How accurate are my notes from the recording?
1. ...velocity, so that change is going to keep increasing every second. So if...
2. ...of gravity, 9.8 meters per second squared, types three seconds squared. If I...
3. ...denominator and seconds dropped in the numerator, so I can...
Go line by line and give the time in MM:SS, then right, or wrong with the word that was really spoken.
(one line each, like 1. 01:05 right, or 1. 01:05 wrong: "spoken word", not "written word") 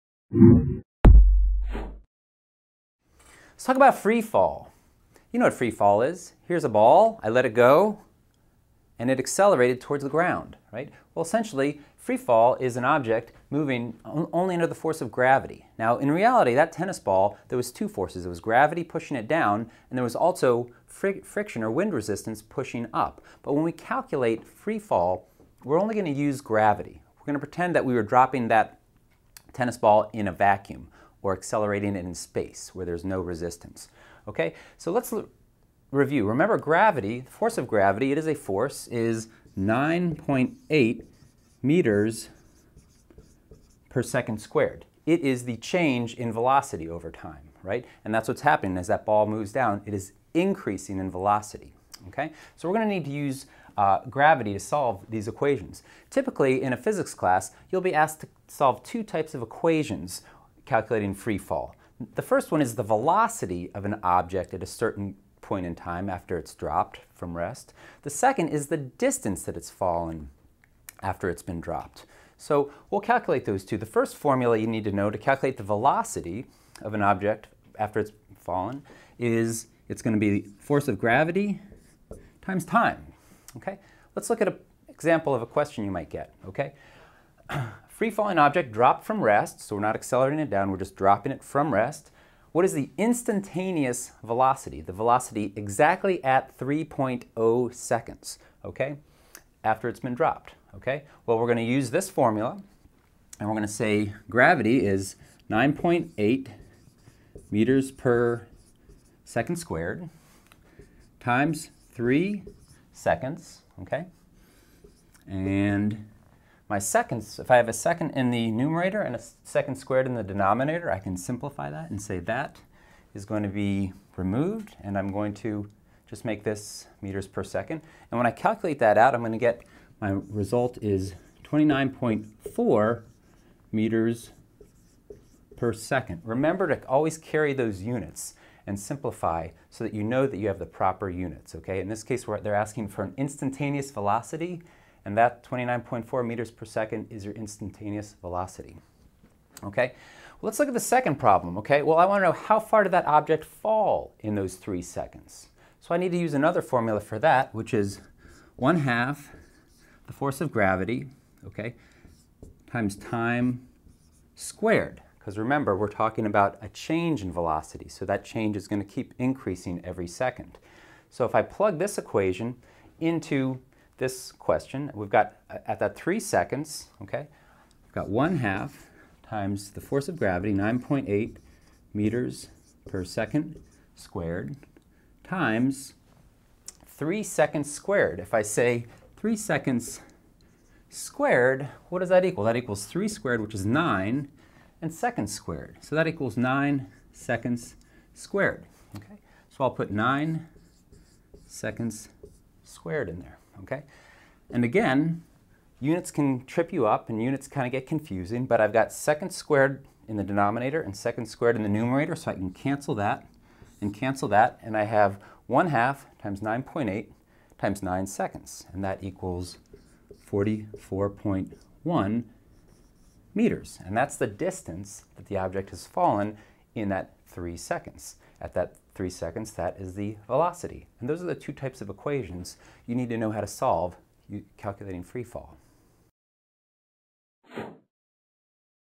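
1. 02:47 right
2. 03:00 wrong: "times", not "types"
3. 03:30 wrong: "squared", not "dropped".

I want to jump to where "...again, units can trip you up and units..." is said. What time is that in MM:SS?
03:24.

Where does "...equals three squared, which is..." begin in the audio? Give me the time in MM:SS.
03:12.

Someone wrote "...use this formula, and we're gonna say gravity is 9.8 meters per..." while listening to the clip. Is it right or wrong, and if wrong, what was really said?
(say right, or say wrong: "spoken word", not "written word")
right.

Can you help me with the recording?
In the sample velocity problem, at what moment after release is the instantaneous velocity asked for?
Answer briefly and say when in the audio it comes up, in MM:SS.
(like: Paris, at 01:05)
3.0 seconds, at 01:36.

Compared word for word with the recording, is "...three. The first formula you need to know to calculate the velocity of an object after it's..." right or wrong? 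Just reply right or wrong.
wrong.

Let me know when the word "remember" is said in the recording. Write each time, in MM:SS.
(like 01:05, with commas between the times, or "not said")
00:36, 02:16, 02:45.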